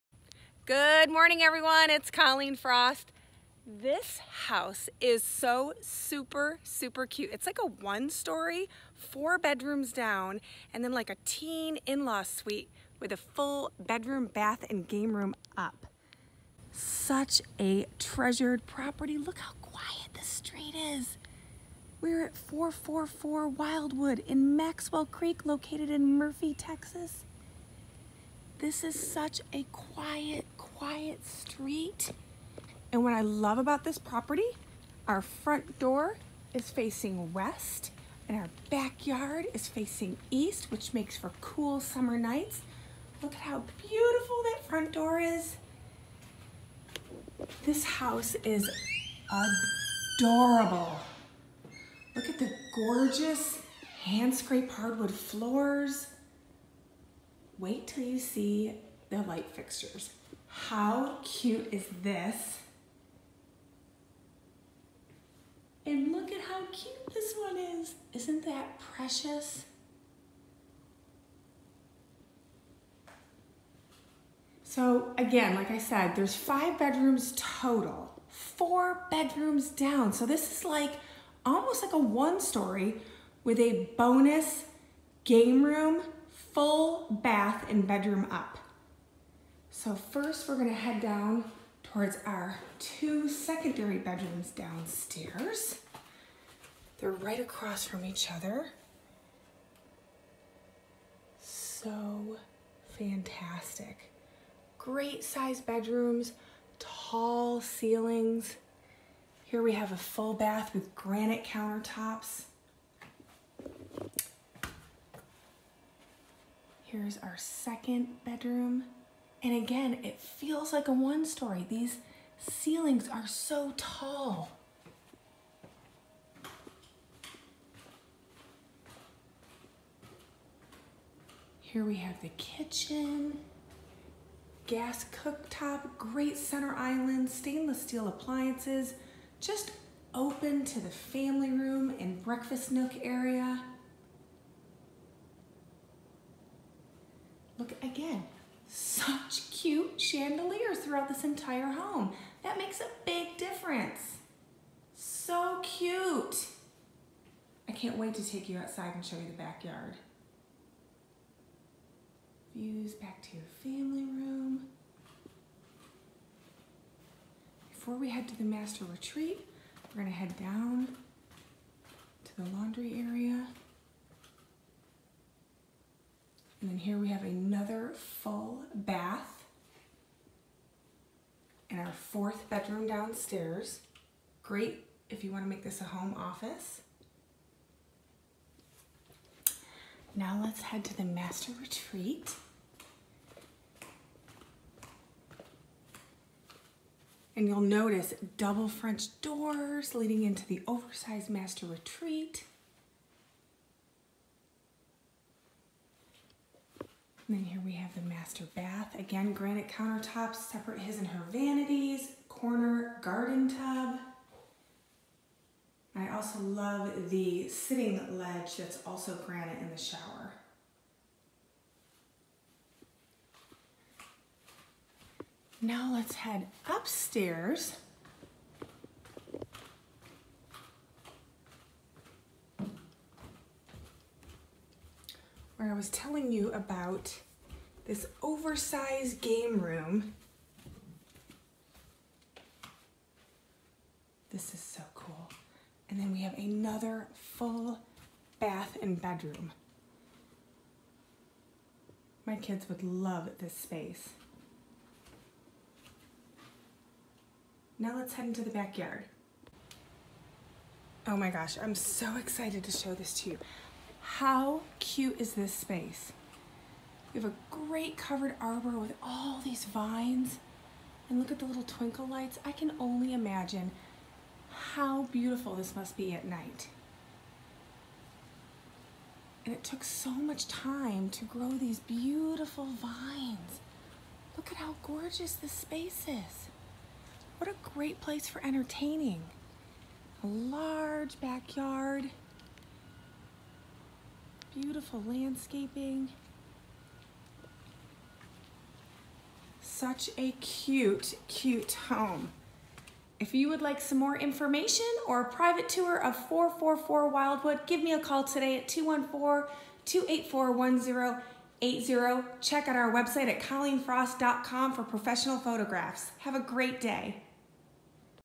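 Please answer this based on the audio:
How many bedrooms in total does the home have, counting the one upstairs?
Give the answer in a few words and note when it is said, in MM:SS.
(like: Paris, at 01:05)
5, at 01:16.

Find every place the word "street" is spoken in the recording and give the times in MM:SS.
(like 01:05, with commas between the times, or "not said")
00:20, 00:31.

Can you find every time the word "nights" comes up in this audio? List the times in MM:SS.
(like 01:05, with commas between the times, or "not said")
00:42, 04:36.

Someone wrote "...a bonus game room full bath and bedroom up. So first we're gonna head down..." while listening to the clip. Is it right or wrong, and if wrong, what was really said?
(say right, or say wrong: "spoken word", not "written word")
right.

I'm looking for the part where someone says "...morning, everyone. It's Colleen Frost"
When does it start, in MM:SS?
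00:01.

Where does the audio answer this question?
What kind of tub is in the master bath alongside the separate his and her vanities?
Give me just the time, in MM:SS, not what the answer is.
03:32.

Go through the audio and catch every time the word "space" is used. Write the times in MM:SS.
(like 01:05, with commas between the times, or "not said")
04:13, 04:25, 04:45.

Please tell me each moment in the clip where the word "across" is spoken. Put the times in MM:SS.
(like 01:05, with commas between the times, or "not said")
01:37.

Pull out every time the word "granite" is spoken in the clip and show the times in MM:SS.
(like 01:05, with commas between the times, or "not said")
01:50, 03:29, 03:39.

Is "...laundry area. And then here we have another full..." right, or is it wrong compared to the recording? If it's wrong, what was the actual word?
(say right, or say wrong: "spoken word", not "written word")
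right.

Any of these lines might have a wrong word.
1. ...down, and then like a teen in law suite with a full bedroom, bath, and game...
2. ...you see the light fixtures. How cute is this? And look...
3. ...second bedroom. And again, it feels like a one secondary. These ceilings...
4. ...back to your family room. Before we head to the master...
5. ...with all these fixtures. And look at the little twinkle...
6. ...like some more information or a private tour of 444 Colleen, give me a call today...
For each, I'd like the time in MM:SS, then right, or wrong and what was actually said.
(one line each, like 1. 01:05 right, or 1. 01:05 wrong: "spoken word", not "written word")
1. 00:09 right
2. 00:58 right
3. 01:57 wrong: "story", not "secondary"
4. 02:42 right
5. 04:28 wrong: "vines", not "fixtures"
6. 05:03 wrong: "Wildwood", not "Colleen".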